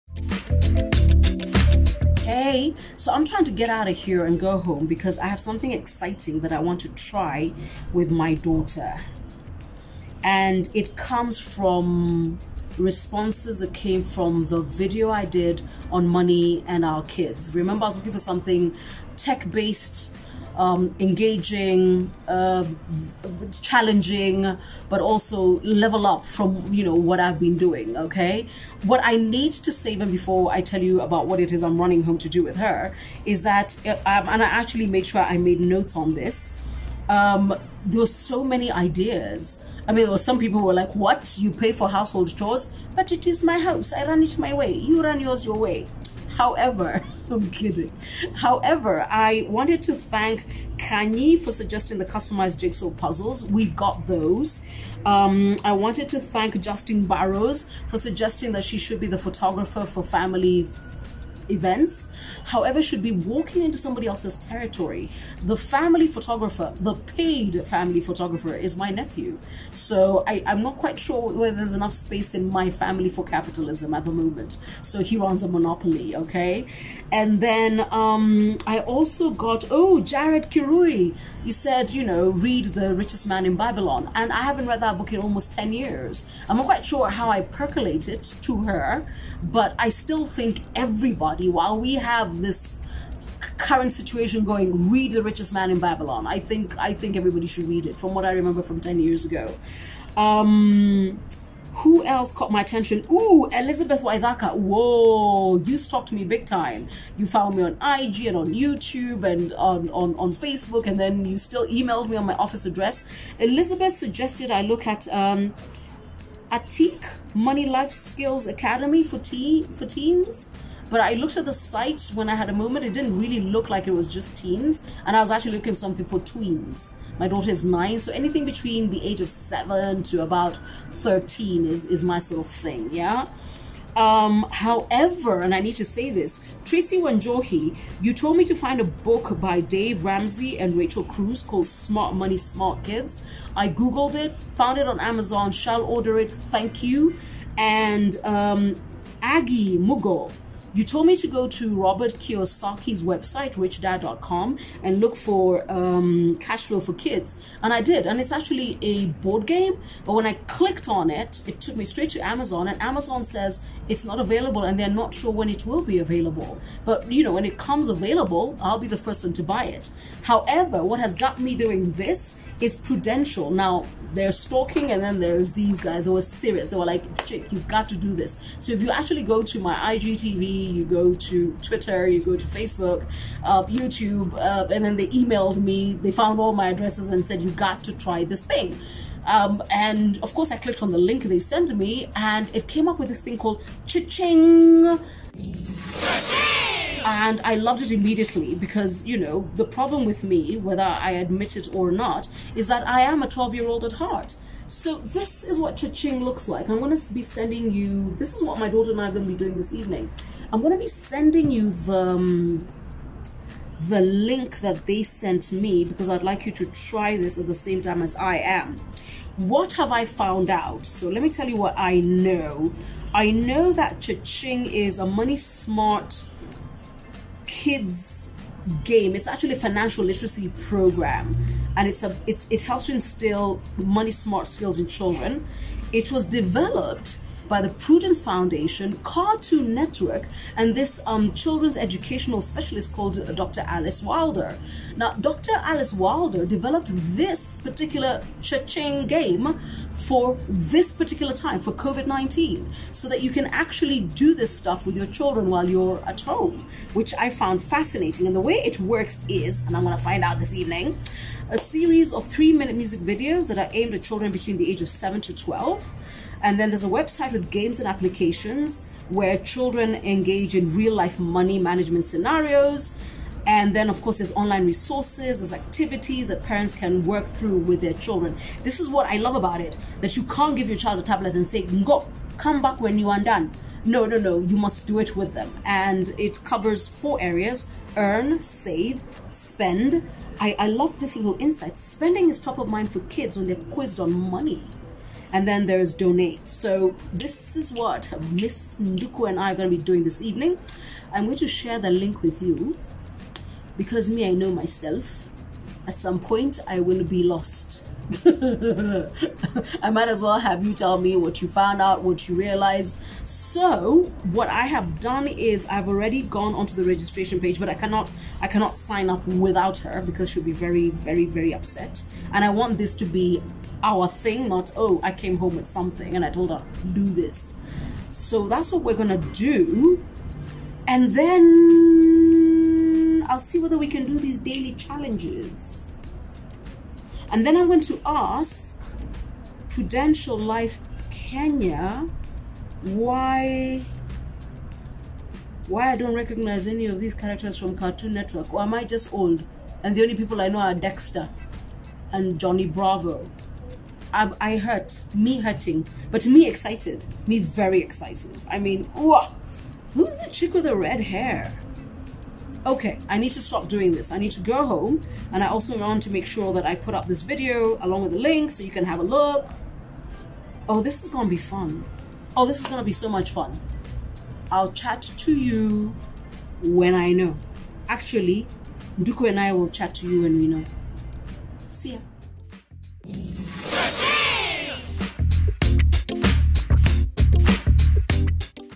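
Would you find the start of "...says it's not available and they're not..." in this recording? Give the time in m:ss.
2:43.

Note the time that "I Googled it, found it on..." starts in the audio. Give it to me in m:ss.
2:23.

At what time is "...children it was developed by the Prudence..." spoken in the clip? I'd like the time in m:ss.
3:54.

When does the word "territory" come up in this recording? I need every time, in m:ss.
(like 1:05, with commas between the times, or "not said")
1:04.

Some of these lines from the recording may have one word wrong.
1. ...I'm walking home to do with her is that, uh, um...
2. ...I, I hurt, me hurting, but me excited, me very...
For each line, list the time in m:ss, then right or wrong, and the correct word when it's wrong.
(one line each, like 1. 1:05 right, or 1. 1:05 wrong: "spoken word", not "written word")
1. 0:31 wrong: "running", not "walking"
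2. 5:54 right.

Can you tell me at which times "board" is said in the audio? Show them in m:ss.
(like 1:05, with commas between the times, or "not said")
2:39.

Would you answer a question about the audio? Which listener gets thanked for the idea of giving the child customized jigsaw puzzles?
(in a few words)
Kanye.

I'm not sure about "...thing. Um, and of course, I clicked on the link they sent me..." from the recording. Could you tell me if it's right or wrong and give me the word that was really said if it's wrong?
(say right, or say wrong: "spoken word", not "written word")
right.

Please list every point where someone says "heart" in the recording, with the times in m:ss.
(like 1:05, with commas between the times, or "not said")
3:23.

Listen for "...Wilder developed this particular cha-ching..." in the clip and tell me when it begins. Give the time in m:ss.
4:05.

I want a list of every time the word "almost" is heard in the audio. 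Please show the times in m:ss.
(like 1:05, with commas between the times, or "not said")
1:25.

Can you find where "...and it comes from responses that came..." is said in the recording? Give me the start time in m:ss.
0:10.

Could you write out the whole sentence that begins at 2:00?
But I looked at the site when I had a moment.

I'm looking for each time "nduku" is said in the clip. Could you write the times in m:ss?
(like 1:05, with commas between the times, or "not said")
4:58, 6:18.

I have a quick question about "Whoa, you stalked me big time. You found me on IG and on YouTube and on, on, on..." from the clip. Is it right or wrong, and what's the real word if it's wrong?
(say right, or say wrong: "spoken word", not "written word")
right.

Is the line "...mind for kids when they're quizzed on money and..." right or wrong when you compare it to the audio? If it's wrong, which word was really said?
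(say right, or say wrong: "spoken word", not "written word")
right.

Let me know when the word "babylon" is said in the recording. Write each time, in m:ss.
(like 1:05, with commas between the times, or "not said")
1:23, 1:35.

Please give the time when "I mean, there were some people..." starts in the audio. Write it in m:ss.
0:39.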